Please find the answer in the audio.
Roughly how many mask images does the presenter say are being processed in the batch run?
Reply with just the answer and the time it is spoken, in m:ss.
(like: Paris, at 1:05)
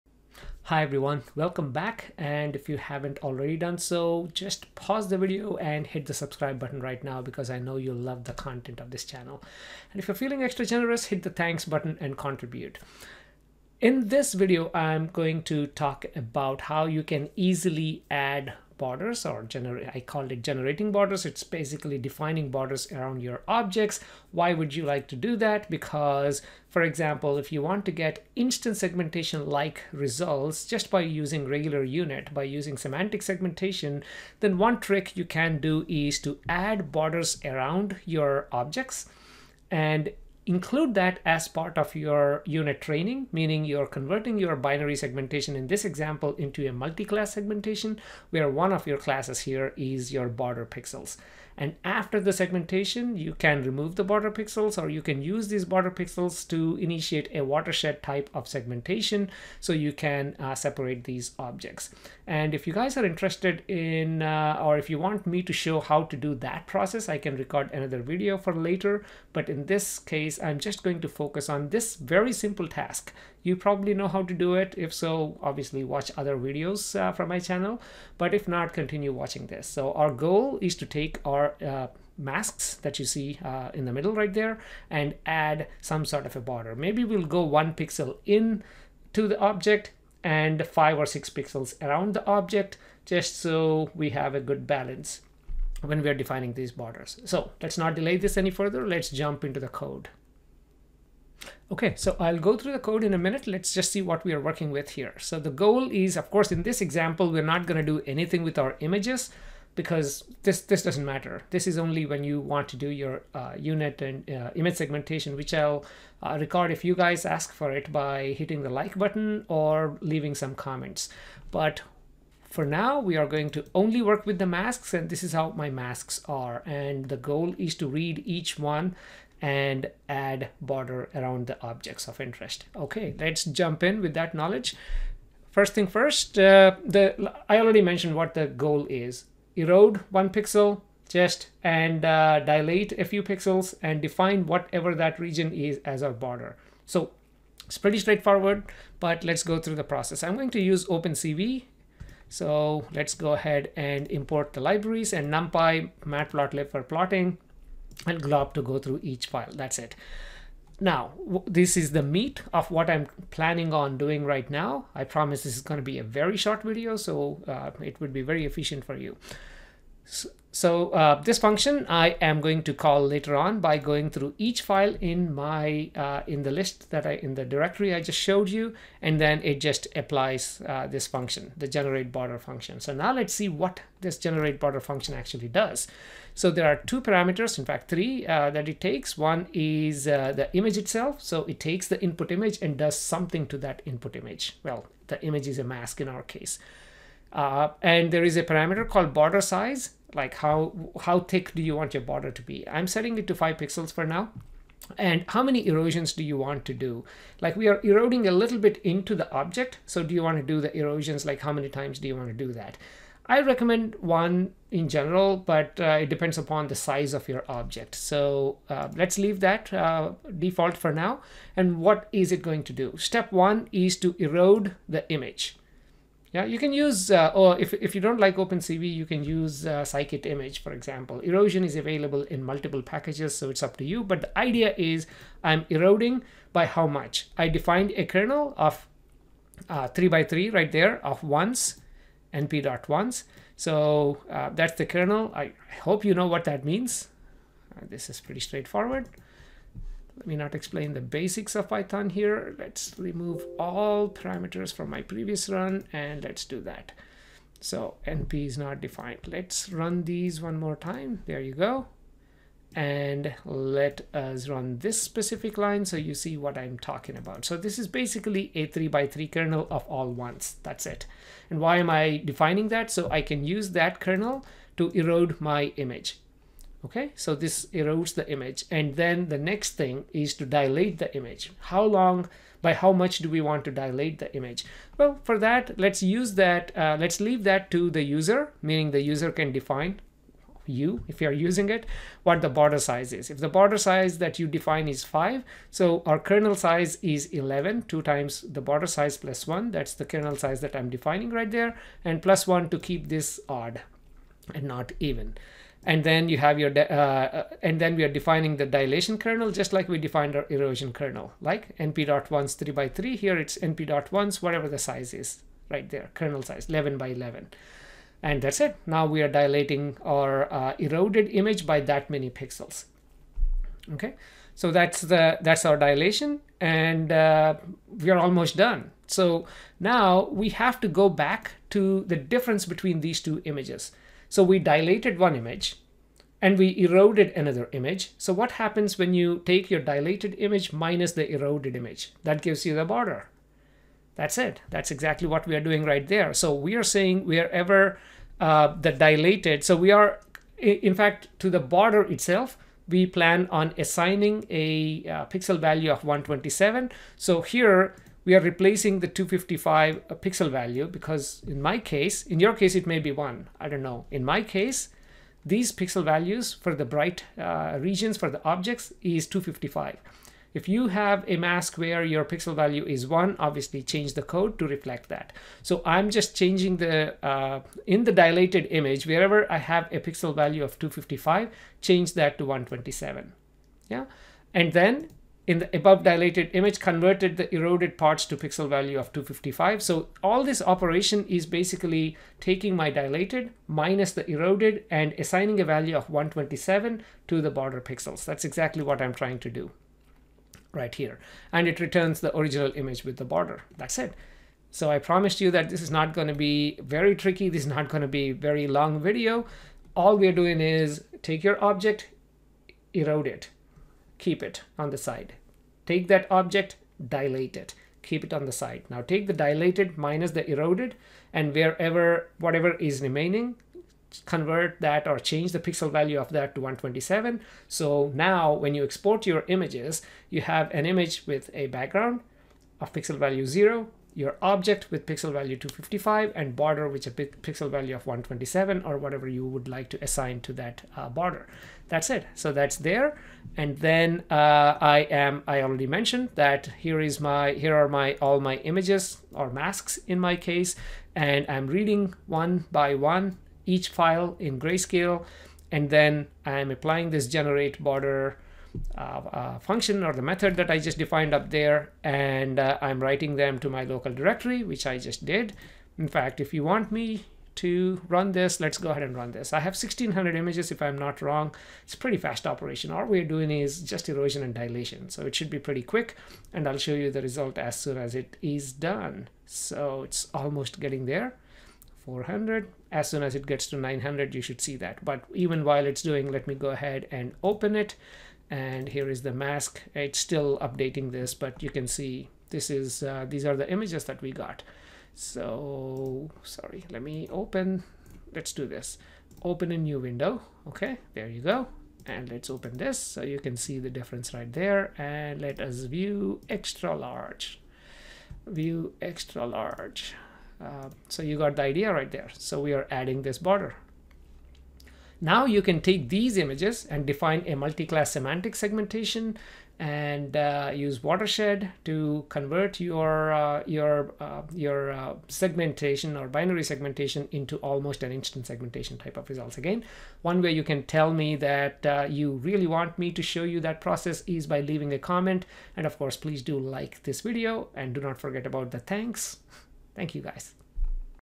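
1600, at 7:49.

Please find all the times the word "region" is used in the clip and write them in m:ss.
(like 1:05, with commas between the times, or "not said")
2:25, 6:07.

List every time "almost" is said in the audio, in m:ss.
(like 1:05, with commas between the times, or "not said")
5:28, 8:00, 8:47.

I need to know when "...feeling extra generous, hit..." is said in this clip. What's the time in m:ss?
0:10.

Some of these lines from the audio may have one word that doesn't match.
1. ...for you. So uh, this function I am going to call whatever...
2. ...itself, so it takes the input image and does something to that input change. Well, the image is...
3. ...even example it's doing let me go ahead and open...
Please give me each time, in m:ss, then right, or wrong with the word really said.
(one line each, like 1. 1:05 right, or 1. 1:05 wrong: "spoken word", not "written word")
1. 2:48 wrong: "later", not "whatever"
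2. 3:10 wrong: "image", not "change"
3. 8:05 wrong: "while", not "example".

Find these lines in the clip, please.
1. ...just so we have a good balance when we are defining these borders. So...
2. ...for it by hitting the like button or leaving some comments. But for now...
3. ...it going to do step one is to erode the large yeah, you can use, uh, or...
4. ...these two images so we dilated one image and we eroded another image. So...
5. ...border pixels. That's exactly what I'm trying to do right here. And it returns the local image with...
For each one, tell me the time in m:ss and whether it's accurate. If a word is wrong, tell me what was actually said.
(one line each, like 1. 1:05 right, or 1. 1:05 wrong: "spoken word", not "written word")
1. 1:33 right
2. 1:57 right
3. 3:42 wrong: "image", not "large"
4. 5:33 right
5. 6:37 wrong: "original", not "local".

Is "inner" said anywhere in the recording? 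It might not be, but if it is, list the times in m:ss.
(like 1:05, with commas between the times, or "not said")
not said.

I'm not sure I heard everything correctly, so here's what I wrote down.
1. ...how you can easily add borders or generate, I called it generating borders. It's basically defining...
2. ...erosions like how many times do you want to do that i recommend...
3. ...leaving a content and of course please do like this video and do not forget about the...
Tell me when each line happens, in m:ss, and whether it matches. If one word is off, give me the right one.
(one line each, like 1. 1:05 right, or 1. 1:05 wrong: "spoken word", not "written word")
1. 0:16 right
2. 3:30 right
3. 8:54 wrong: "comment", not "content".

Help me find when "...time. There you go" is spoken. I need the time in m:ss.
4:20.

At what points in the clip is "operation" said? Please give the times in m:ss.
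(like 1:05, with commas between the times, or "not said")
6:30, 7:52.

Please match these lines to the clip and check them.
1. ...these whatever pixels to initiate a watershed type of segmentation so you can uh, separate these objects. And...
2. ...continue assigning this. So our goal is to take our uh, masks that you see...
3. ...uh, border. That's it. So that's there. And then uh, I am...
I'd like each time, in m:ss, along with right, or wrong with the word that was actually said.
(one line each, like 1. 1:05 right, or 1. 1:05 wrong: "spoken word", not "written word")
1. 0:55 wrong: "border", not "whatever"
2. 1:18 wrong: "watching", not "assigning"
3. 7:20 right.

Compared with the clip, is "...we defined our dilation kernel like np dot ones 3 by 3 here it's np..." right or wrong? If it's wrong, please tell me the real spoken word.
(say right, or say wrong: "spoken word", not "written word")
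wrong: "erosion", not "dilation".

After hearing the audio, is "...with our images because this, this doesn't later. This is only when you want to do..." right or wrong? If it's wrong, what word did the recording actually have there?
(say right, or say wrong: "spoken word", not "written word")
wrong: "matter", not "later".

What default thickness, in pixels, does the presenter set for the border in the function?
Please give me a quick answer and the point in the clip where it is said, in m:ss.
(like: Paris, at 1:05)
5, at 3:23.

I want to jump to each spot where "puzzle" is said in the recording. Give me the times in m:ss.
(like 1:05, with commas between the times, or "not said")
not said.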